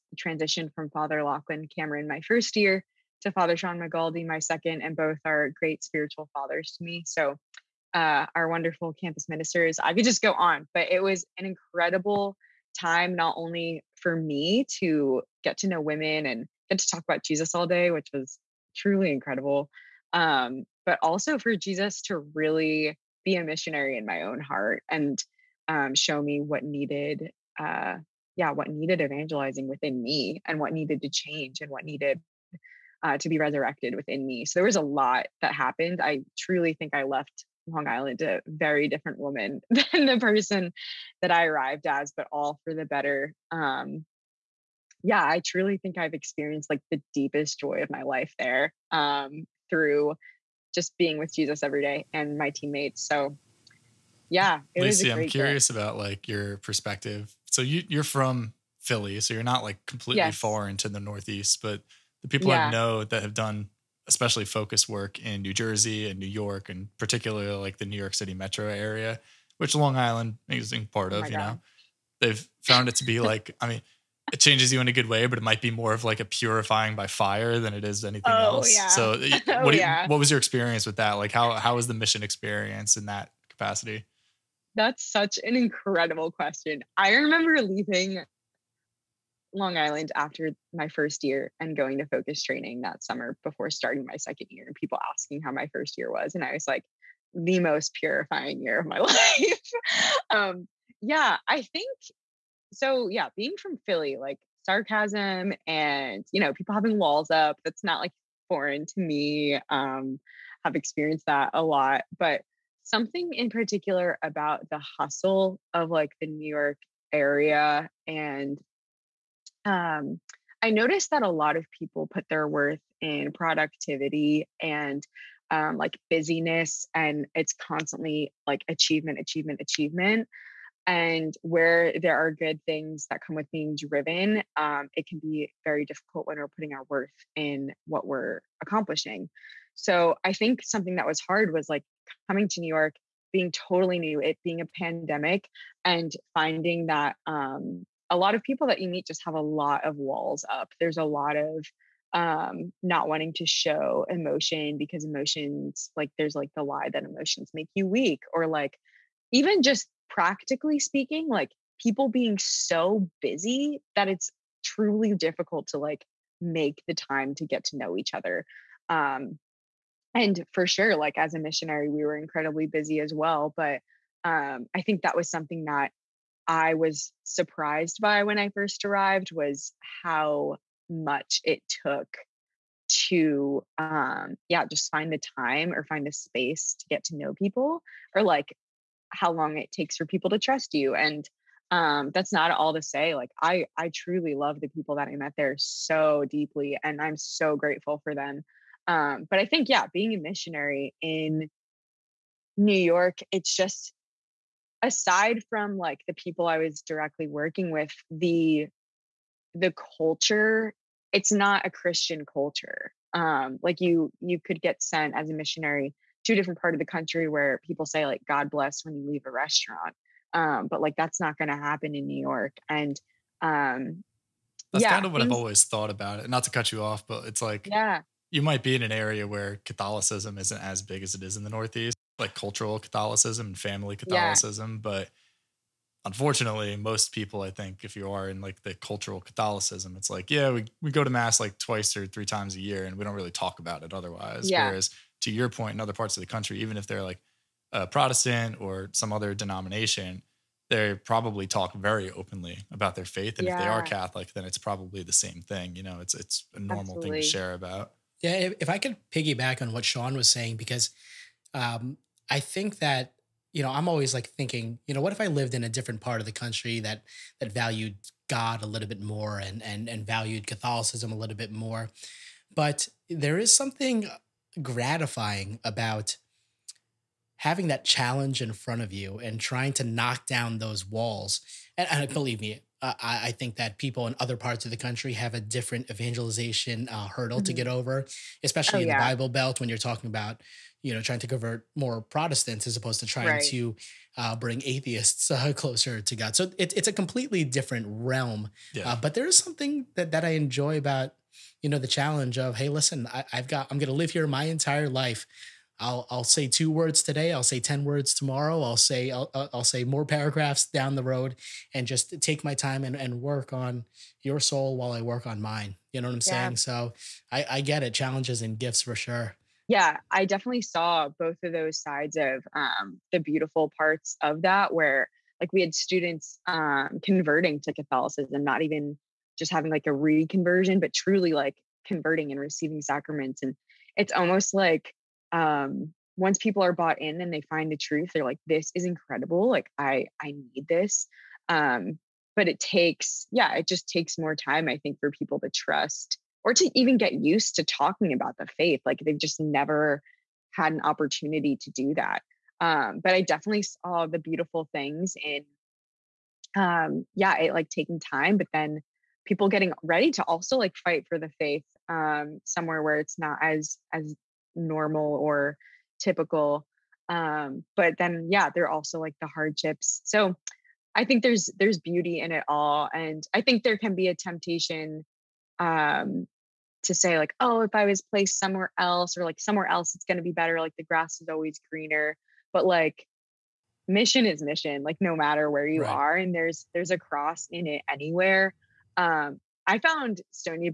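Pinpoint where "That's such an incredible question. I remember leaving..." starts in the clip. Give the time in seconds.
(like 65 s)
84 s.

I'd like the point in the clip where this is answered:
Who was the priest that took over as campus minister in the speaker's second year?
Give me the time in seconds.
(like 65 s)
3 s.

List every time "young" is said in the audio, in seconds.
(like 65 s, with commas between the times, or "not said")
not said.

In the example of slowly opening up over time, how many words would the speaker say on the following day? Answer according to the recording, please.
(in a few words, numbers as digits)
10.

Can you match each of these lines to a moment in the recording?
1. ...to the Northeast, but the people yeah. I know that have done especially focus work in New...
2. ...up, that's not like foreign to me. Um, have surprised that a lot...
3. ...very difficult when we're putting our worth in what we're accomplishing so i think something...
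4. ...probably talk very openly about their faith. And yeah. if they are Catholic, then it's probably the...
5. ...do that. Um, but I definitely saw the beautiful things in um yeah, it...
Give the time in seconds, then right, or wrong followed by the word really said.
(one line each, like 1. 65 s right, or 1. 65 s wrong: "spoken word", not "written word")
1. 60 s right
2. 107 s wrong: "experienced", not "surprised"
3. 135 s right
4. 250 s right
5. 351 s right.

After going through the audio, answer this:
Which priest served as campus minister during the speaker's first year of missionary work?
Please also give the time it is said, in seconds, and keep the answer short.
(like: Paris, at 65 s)
Father Lachlan Cameron, at 0 s.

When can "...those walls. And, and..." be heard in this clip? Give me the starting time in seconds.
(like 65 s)
280 s.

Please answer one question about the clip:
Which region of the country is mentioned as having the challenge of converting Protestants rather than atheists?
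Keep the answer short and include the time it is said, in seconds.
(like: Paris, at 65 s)
the Bible Belt, at 288 s.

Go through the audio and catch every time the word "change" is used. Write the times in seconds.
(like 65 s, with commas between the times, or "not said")
31 s, 74 s.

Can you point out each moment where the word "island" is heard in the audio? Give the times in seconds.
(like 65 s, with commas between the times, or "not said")
37 s, 69 s, 89 s.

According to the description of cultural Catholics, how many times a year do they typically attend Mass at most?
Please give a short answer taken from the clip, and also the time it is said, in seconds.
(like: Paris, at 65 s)
3, at 242 s.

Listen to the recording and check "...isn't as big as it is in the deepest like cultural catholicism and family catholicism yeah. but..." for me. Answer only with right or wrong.
wrong.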